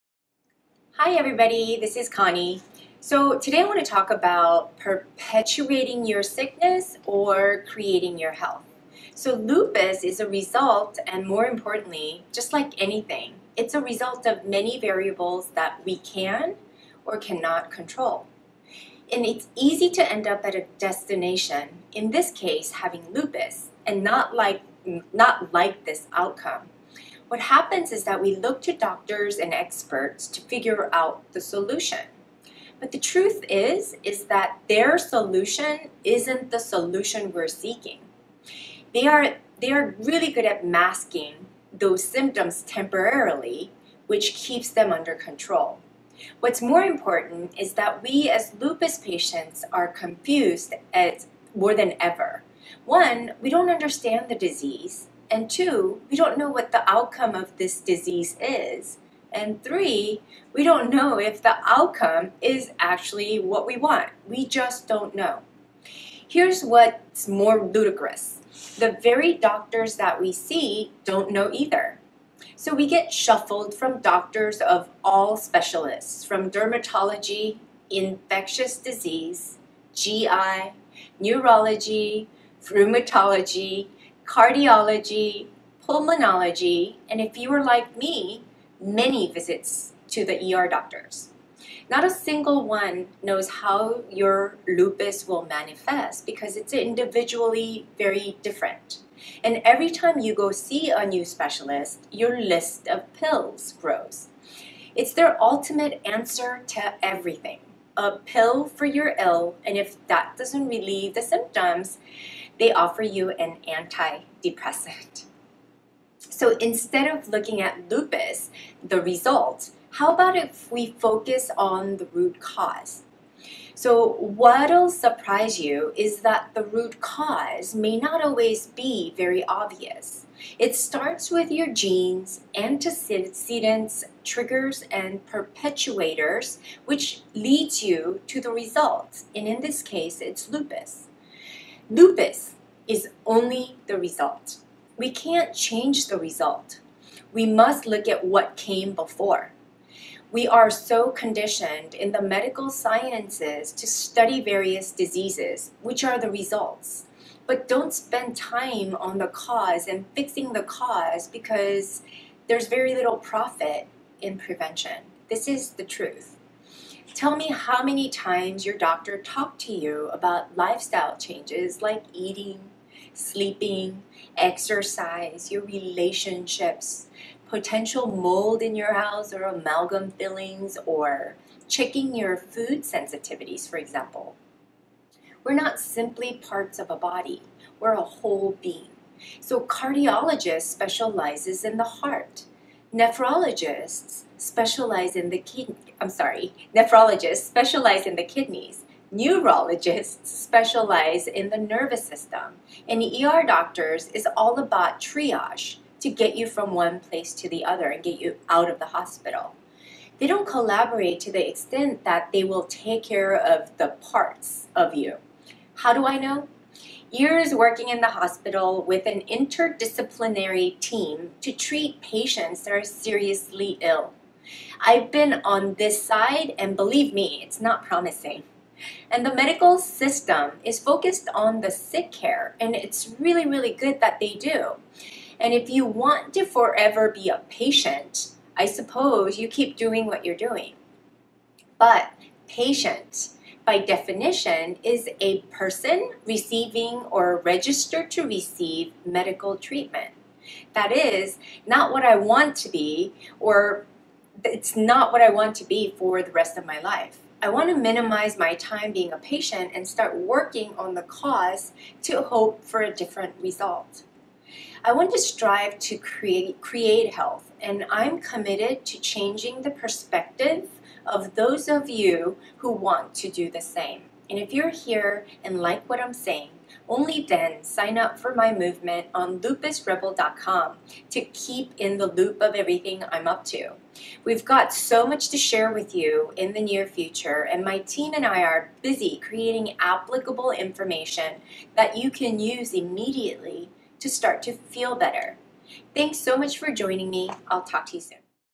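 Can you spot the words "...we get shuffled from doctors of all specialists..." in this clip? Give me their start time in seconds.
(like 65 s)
72 s.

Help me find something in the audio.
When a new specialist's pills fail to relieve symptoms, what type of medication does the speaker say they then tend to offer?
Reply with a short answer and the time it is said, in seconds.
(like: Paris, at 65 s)
An antidepressant, at 113 s.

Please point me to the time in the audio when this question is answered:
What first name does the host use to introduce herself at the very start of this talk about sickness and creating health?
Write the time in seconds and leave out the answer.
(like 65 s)
2 s.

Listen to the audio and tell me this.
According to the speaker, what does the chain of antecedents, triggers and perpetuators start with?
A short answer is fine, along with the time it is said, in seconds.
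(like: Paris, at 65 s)
Genes, at 131 s.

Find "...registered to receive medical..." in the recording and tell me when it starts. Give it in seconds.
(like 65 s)
247 s.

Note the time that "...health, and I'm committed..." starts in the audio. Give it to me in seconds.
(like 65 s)
267 s.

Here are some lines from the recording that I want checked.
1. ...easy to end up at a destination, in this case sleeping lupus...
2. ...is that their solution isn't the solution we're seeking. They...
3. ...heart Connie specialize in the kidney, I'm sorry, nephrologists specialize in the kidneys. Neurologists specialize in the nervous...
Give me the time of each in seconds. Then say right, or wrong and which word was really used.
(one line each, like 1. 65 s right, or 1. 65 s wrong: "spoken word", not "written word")
1. 19 s wrong: "having", not "sleeping"
2. 34 s right
3. 191 s wrong: "Nephrologists", not "Connie".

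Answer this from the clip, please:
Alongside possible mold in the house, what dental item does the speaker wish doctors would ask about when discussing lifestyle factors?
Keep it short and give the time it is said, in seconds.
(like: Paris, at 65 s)
Amalgam fillings, at 179 s.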